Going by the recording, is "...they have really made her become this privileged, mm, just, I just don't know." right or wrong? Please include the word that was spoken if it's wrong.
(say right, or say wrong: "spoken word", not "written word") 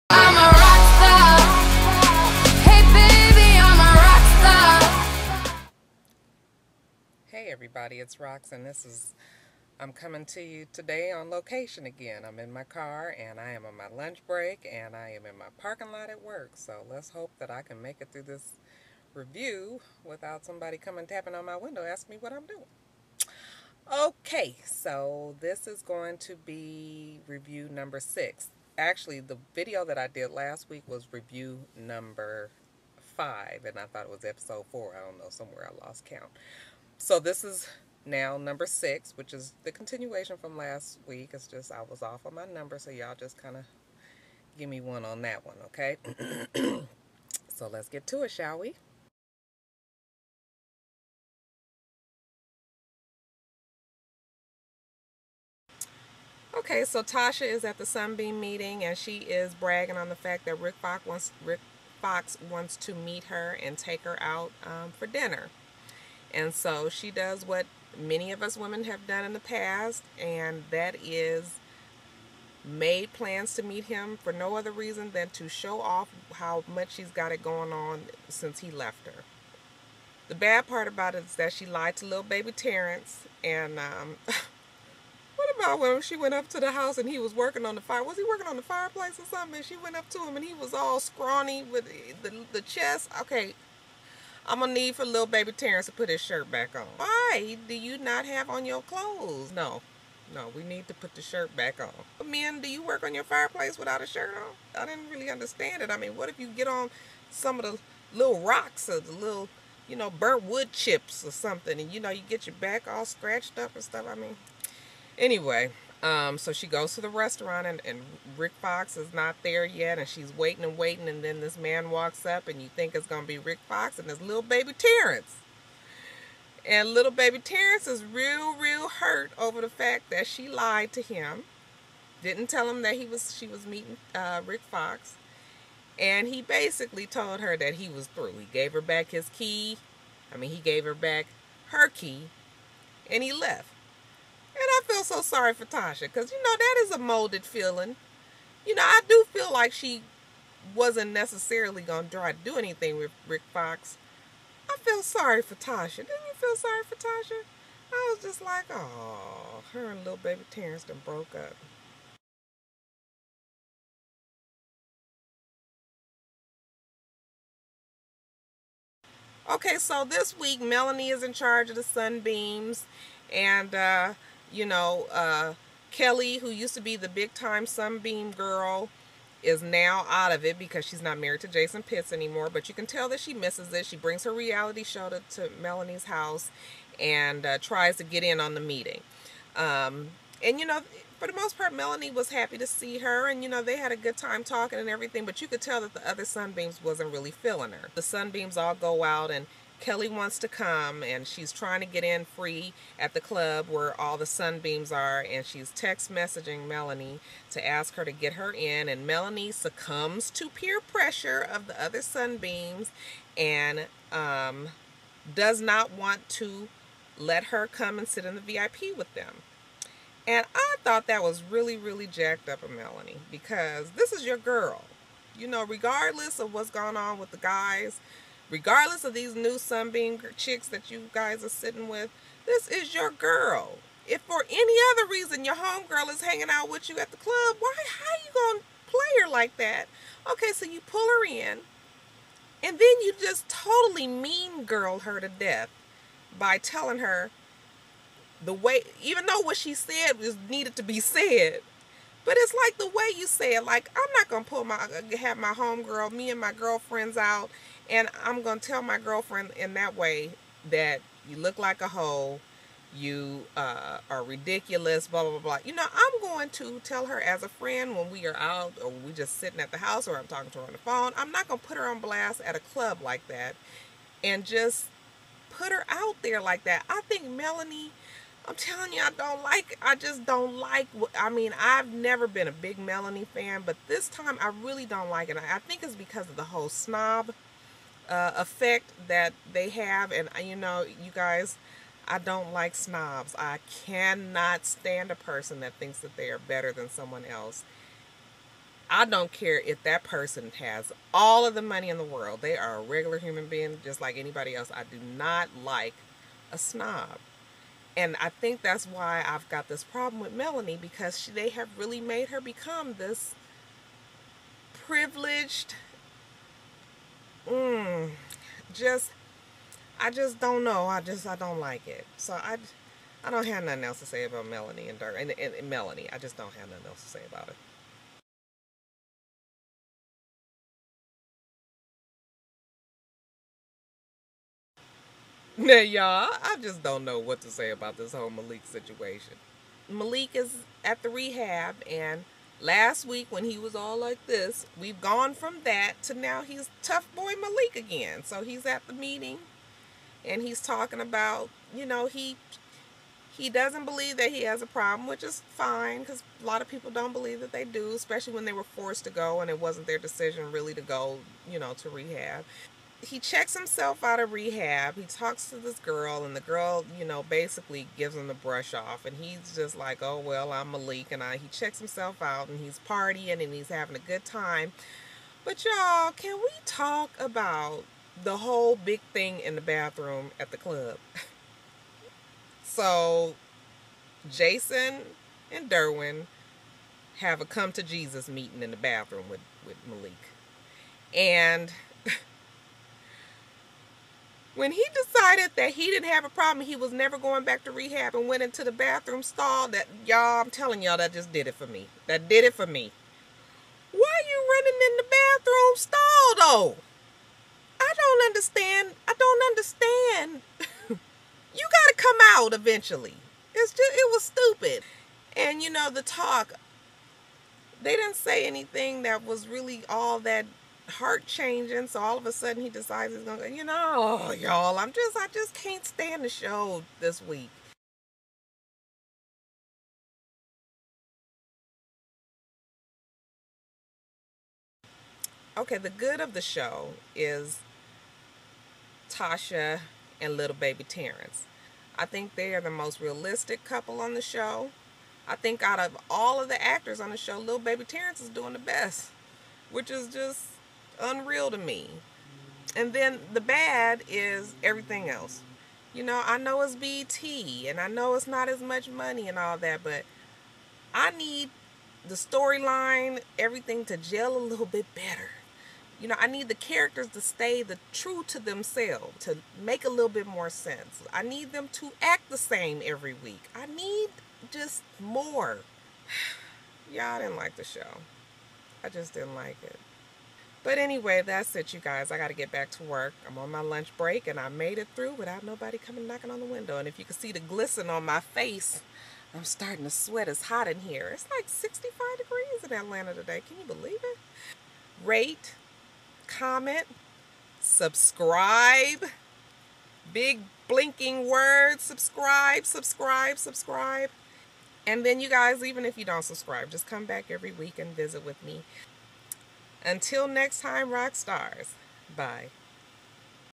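right.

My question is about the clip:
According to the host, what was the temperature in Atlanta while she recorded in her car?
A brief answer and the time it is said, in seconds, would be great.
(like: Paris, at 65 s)
65 degrees, at 491 s.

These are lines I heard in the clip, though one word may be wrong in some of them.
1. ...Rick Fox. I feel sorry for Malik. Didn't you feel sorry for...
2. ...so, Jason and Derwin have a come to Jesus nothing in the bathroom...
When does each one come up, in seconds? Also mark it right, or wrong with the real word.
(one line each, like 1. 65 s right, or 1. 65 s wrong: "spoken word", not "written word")
1. 153 s wrong: "Tasha", not "Malik"
2. 382 s wrong: "meeting", not "nothing".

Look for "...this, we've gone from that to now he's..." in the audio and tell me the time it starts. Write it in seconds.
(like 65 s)
344 s.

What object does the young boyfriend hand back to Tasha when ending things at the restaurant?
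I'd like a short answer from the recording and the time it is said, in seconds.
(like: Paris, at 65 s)
Her key, at 141 s.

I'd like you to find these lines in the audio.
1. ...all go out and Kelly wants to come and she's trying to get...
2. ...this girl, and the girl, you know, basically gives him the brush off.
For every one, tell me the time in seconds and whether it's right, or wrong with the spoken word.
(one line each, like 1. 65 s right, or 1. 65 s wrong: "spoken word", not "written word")
1. 198 s right
2. 365 s right.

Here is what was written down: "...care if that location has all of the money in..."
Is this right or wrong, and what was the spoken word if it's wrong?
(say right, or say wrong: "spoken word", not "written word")
wrong: "person", not "location".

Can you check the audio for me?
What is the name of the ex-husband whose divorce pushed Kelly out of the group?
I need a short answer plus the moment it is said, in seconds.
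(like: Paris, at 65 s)
Jason Pitts, at 181 s.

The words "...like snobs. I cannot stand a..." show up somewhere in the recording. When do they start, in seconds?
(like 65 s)
292 s.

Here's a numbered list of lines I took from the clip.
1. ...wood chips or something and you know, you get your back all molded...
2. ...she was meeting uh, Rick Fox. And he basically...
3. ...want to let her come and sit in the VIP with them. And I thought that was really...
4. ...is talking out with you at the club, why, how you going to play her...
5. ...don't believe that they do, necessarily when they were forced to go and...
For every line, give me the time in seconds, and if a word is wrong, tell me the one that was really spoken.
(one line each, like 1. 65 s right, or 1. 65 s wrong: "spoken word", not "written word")
1. 110 s wrong: "scratched", not "molded"
2. 133 s right
3. 215 s right
4. 236 s wrong: "hanging", not "talking"
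5. 356 s wrong: "especially", not "necessarily".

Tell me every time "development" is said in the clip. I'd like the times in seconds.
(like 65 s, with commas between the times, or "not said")
not said.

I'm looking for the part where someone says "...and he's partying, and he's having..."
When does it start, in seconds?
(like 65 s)
372 s.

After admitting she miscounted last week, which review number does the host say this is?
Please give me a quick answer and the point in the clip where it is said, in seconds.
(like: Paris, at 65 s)
6, at 38 s.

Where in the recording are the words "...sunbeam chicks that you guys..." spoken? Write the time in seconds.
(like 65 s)
229 s.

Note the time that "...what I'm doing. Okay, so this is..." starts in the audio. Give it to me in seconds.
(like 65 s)
22 s.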